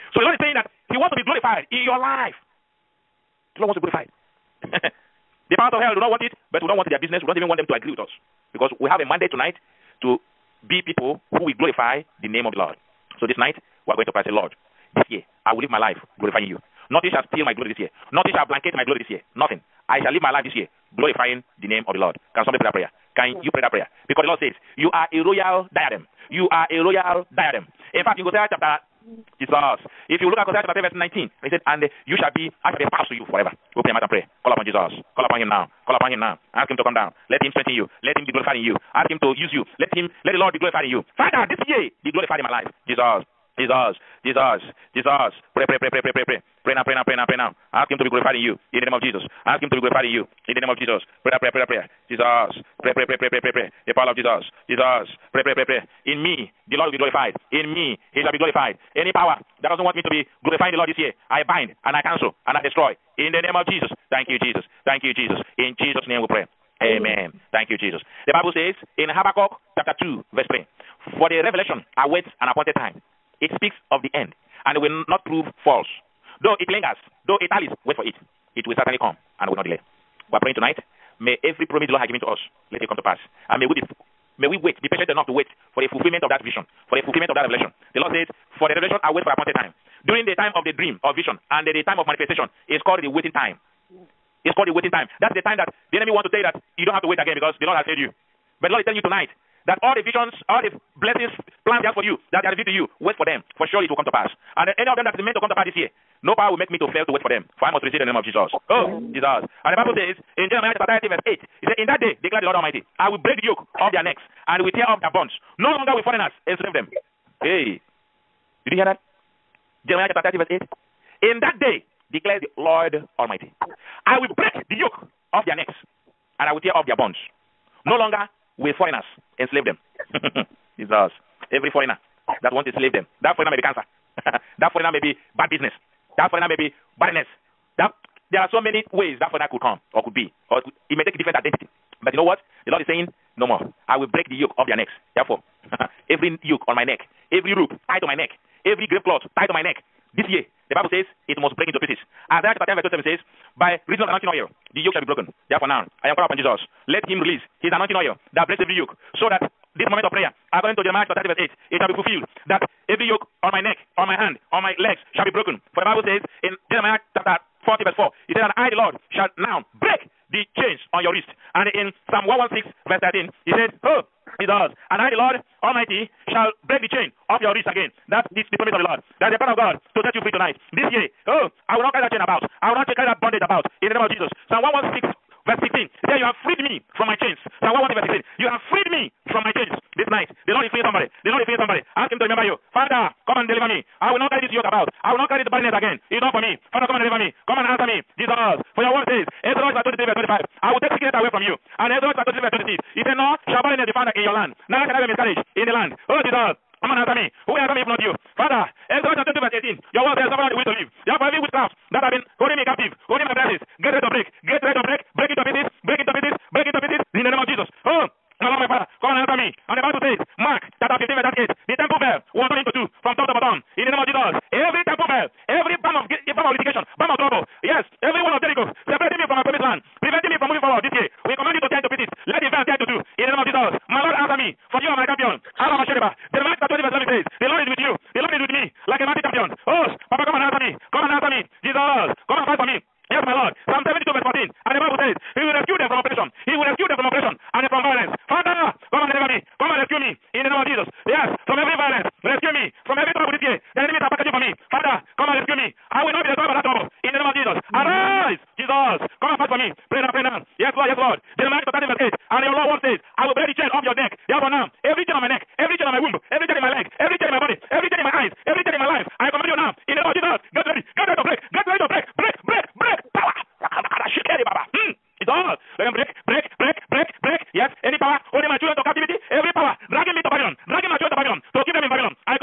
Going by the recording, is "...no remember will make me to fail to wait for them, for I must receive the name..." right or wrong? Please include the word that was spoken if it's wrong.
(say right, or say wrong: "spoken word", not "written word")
wrong: "power", not "remember".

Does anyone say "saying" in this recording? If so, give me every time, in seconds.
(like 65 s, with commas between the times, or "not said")
0 s, 142 s.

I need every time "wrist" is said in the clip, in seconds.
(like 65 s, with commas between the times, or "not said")
171 s, 177 s.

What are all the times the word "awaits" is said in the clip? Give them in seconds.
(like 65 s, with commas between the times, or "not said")
71 s.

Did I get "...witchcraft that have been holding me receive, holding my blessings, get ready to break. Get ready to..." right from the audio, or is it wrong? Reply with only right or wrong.
wrong.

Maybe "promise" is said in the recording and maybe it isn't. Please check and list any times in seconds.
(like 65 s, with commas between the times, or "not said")
81 s, 178 s.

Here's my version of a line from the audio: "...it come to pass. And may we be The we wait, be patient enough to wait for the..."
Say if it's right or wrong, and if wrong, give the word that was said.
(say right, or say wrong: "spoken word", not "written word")
wrong: "May", not "The".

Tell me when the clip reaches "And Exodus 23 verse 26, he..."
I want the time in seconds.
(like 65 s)
201 s.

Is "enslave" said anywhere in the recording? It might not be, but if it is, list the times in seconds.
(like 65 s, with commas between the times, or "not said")
116 s, 129 s.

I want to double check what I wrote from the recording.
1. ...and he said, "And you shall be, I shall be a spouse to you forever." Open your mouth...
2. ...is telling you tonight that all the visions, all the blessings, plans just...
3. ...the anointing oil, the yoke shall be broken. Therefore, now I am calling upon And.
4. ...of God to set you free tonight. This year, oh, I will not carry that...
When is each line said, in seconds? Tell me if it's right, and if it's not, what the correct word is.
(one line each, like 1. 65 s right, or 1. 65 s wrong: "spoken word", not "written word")
1. 31 s right
2. 98 s right
3. 154 s wrong: "Jesus", not "And"
4. 179 s right.